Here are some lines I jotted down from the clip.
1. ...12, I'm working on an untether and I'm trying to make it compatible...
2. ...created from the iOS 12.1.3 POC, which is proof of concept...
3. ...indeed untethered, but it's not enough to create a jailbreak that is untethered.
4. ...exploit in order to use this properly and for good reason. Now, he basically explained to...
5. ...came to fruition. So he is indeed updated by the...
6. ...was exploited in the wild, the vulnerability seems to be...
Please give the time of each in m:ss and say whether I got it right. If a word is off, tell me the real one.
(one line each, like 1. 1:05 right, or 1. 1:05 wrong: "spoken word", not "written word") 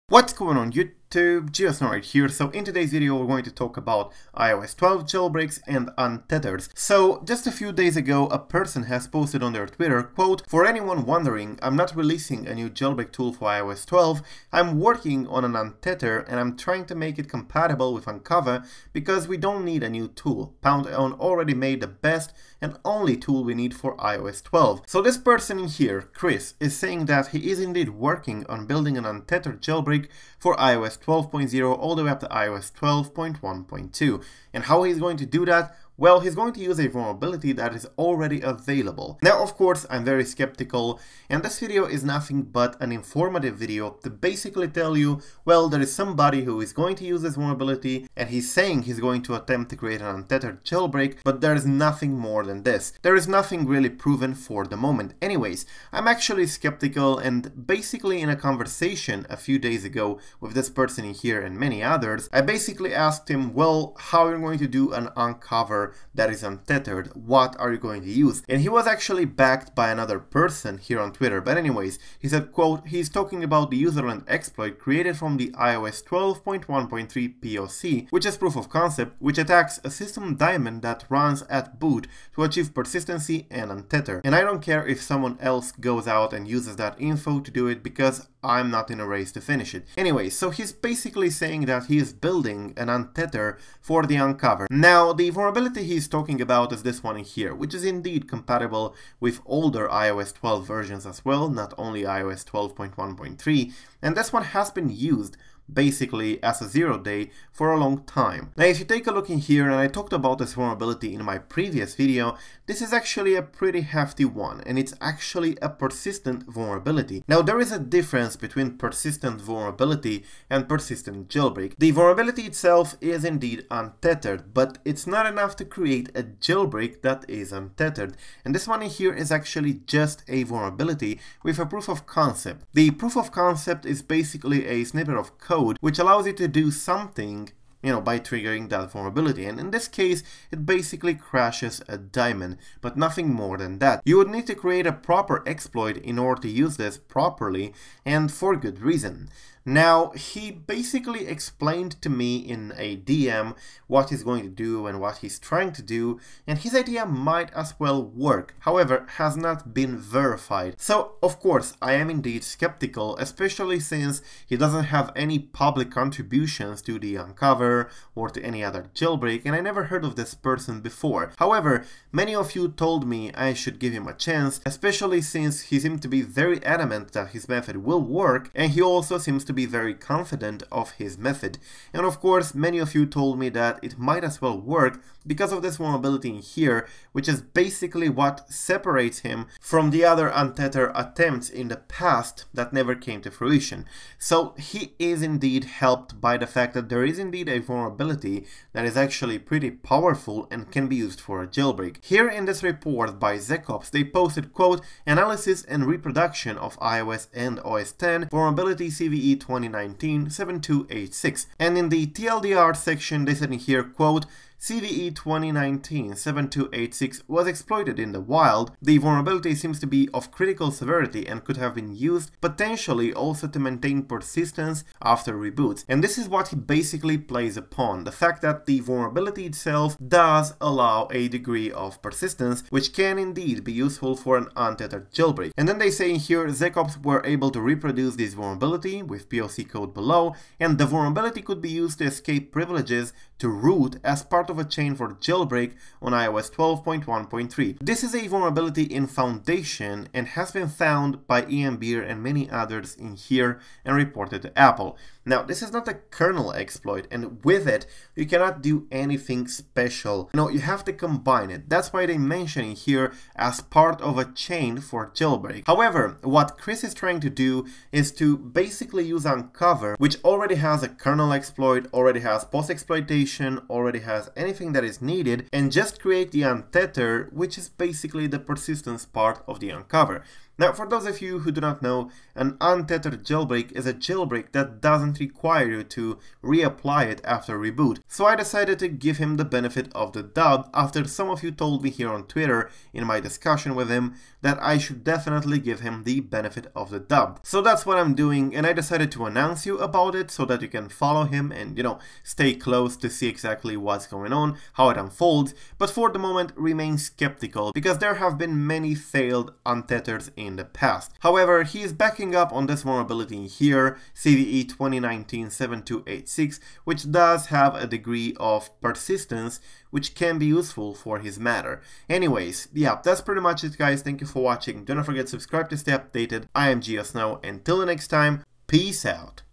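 1. 0:13 right
2. 1:14 right
3. 2:03 right
4. 2:25 right
5. 3:12 wrong: "helped", not "updated"
6. 3:37 right.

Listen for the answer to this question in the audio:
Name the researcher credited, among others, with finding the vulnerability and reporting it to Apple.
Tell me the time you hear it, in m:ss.
4:11.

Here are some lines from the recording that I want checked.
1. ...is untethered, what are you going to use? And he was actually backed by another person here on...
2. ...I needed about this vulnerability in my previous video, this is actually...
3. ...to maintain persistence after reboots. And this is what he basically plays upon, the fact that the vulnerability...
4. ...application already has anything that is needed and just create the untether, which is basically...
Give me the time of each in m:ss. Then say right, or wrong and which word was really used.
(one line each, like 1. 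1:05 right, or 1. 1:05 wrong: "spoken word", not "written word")
1. 1:06 right
2. 1:49 wrong: "talked", not "needed"
3. 3:43 right
4. 4:33 right.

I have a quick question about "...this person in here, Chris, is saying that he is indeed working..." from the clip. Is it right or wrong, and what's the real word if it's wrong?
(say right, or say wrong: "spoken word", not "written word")
right.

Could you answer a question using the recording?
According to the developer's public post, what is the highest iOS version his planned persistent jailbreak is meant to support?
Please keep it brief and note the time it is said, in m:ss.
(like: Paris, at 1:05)
iOS 12.1.2, at 0:32.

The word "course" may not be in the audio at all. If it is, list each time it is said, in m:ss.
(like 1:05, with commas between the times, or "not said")
0:39, 2:41, 3:02.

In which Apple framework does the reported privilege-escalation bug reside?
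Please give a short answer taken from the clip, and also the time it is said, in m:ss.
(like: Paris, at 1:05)
Foundation, at 4:09.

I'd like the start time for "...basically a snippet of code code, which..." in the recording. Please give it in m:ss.
2:14.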